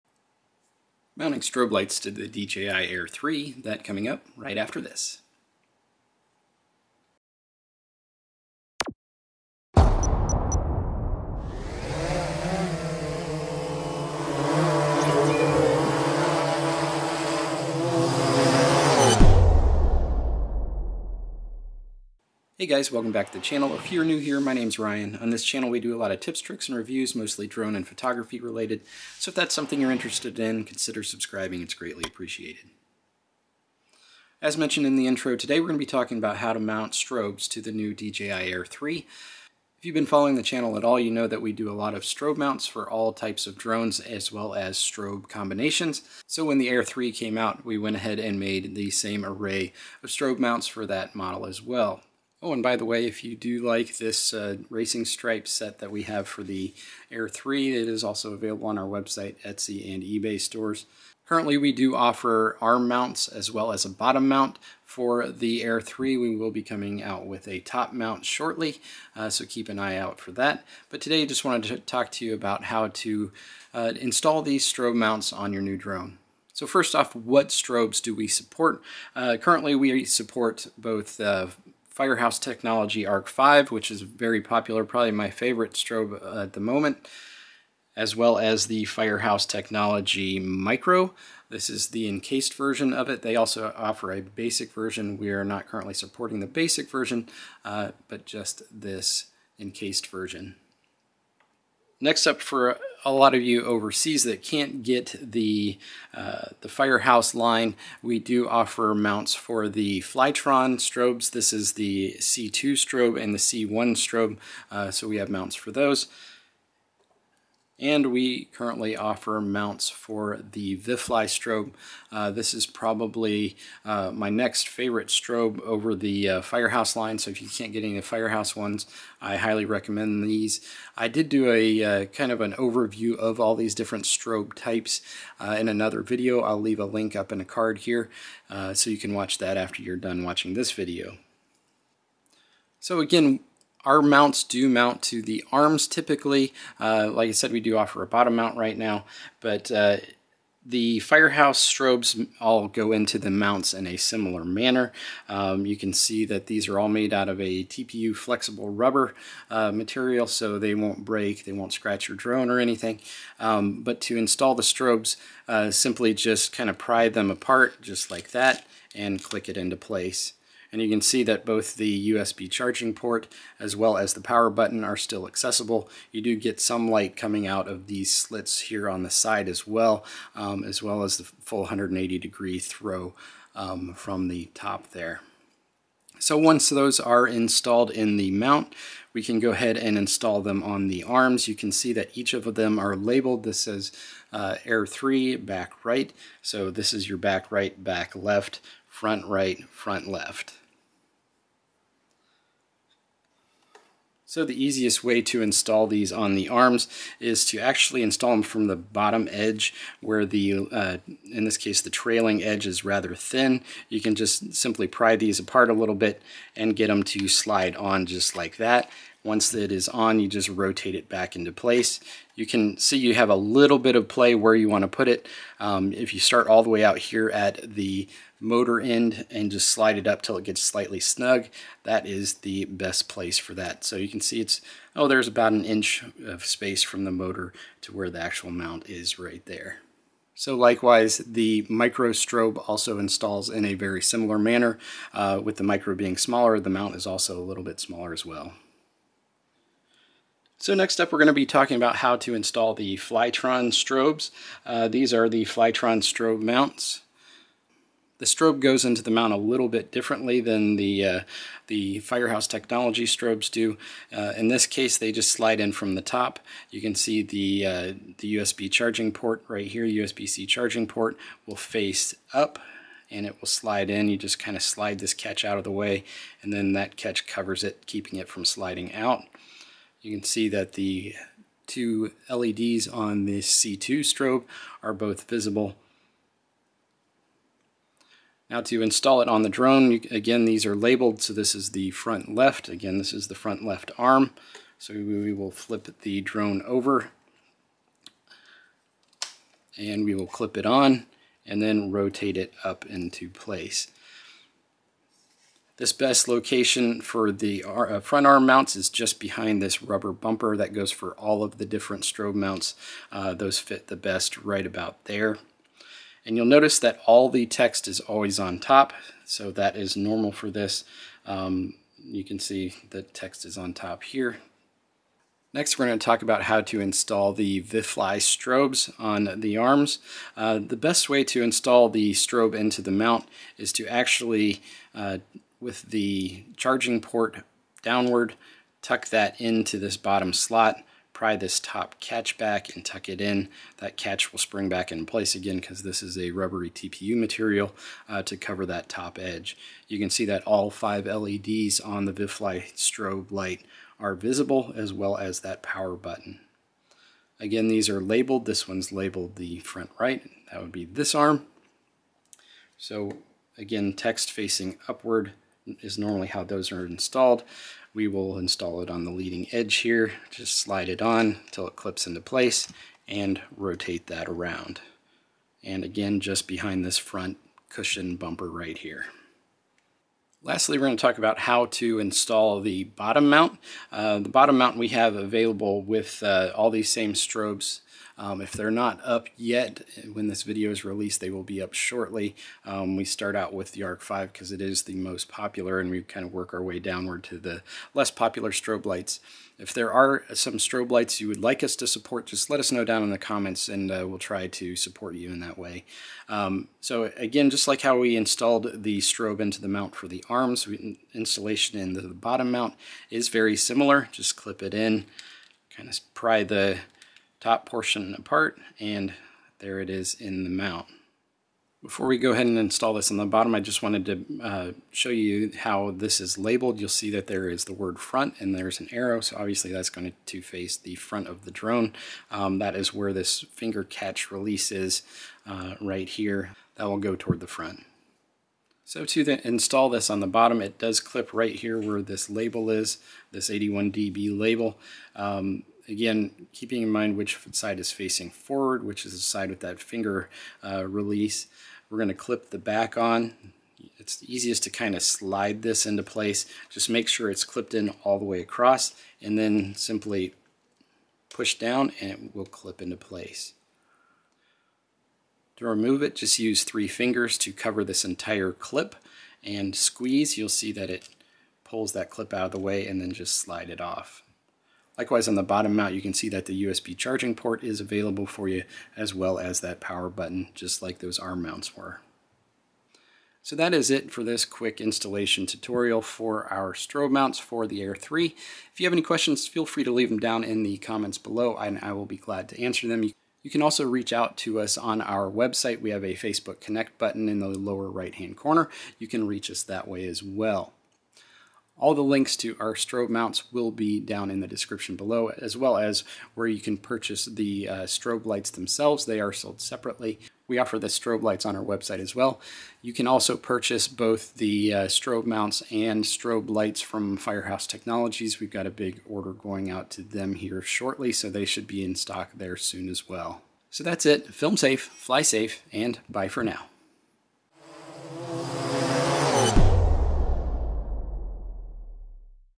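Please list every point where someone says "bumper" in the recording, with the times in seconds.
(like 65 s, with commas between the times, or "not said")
310 s, 378 s.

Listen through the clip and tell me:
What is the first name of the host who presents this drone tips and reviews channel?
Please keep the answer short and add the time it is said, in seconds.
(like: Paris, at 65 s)
Ryan, at 24 s.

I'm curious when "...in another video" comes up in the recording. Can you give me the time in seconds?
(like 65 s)
135 s.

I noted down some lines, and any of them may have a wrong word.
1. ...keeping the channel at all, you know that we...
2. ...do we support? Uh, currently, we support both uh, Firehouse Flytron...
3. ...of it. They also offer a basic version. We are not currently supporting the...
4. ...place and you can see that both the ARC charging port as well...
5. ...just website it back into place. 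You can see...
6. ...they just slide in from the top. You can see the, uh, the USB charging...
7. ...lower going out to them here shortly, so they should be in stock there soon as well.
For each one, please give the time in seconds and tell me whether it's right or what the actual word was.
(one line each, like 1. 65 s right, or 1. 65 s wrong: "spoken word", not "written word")
1. 40 s wrong: "following", not "keeping"
2. 78 s wrong: "Technology", not "Flytron"
3. 92 s right
4. 169 s wrong: "USB", not "ARC"
5. 220 s wrong: "rotate", not "website"
6. 264 s right
7. 519 s wrong: "order", not "lower".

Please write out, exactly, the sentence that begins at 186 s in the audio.
So once those are installed in the mount, we can go ahead and install them on the arms.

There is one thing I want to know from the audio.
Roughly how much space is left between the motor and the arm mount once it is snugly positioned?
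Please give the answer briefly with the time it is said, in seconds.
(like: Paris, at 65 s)
about an inch, at 235 s.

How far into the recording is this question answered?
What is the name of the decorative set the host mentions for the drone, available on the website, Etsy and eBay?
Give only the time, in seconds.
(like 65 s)
54 s.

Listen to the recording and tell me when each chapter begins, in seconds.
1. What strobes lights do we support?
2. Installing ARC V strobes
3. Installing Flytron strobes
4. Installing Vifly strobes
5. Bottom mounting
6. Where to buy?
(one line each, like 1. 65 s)
1. 61 s
2. 141 s
3. 249 s
4. 325 s
5. 380 s
6. 482 s.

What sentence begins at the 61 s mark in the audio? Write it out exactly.
Currently, we do offer arm mounts as well as a bottom mount.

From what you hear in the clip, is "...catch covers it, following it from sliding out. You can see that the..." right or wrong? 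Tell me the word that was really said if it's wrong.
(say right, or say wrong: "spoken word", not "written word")
wrong: "keeping", not "following".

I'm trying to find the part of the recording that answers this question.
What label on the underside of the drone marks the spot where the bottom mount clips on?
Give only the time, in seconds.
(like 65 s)
443 s.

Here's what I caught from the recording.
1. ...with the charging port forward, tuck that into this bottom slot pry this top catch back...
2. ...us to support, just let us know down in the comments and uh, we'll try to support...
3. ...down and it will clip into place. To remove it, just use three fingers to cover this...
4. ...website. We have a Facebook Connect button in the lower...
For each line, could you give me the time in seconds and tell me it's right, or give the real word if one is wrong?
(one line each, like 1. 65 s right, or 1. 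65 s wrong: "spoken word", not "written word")
1. 335 s wrong: "downward", not "forward"
2. 401 s right
3. 461 s right
4. 495 s right.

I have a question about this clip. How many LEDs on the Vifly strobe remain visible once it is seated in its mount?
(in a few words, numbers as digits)
5.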